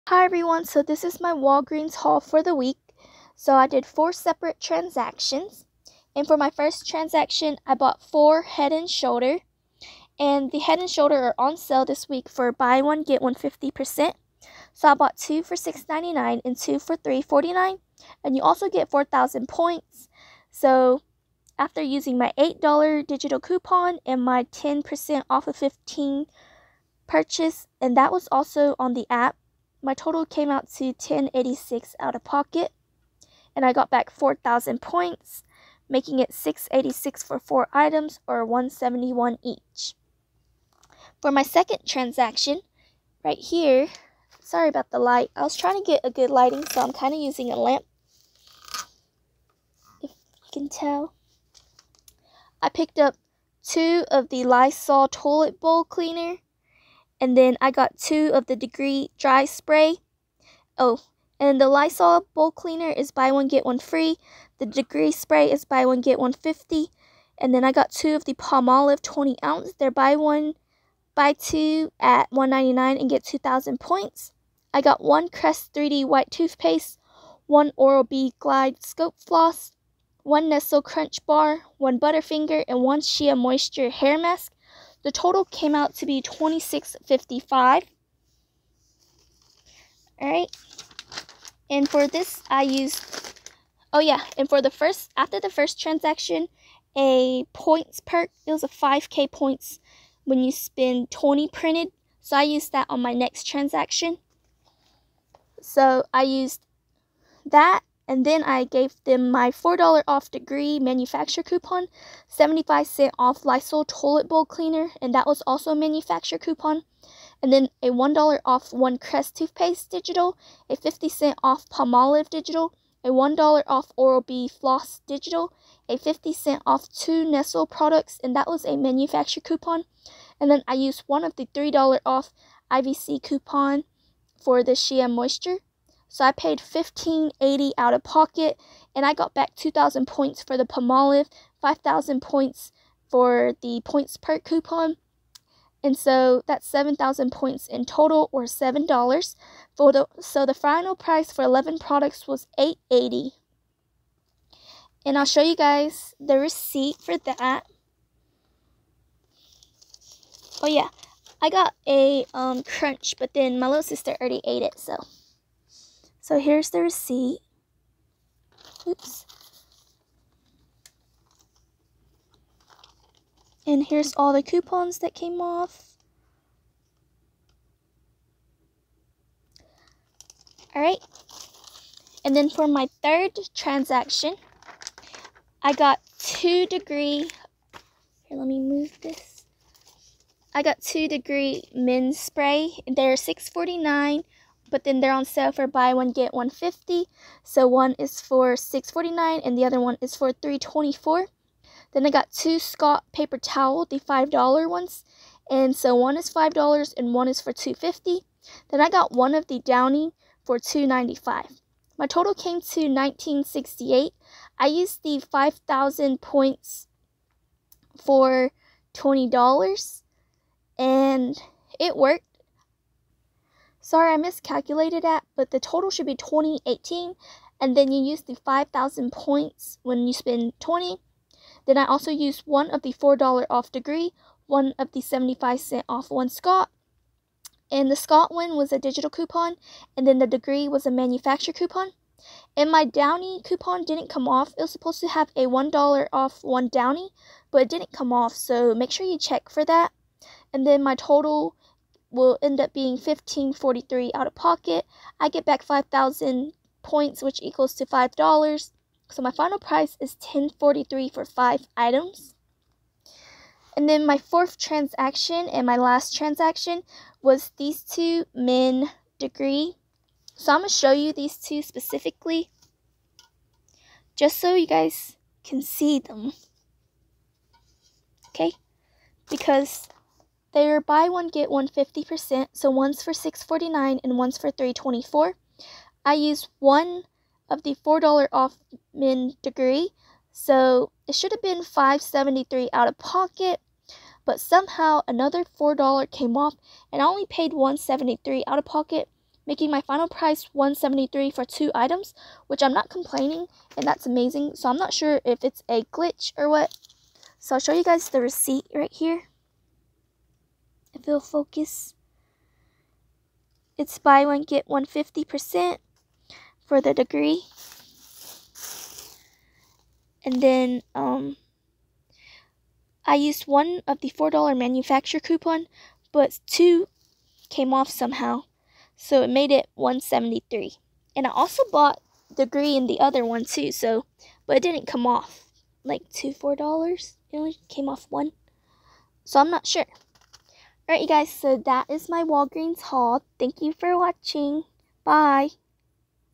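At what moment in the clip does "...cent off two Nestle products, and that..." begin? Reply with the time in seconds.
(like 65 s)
126 s.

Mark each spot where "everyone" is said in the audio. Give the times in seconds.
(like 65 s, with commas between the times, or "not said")
0 s.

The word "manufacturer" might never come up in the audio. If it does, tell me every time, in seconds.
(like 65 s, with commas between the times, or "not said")
110 s, 115 s, 128 s, 240 s, 324 s.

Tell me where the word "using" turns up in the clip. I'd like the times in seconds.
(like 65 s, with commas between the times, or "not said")
21 s, 47 s.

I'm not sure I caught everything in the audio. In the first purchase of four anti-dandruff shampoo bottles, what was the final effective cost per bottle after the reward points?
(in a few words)
$1.71.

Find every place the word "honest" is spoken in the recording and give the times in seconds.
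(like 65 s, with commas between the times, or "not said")
not said.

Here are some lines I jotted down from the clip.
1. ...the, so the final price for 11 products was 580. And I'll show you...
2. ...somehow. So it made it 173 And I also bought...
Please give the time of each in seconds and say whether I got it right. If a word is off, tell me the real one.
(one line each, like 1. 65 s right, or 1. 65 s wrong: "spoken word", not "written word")
1. 149 s wrong: "880", not "580"
2. 327 s right.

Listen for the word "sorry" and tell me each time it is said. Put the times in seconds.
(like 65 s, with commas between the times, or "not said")
44 s, 223 s.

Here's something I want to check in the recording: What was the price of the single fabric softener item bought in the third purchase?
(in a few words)
$2.95.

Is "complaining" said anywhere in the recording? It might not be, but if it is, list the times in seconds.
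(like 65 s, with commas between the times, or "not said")
302 s.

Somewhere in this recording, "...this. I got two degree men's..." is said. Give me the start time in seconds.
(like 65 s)
189 s.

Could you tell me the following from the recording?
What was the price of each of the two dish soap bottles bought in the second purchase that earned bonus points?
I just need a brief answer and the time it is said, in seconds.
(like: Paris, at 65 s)
$1.99, at 72 s.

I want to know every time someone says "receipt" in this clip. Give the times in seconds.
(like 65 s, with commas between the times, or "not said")
156 s, 166 s, 308 s.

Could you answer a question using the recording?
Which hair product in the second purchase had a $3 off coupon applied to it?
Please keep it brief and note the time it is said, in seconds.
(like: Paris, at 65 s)
Shea Moisture hair mask, at 83 s.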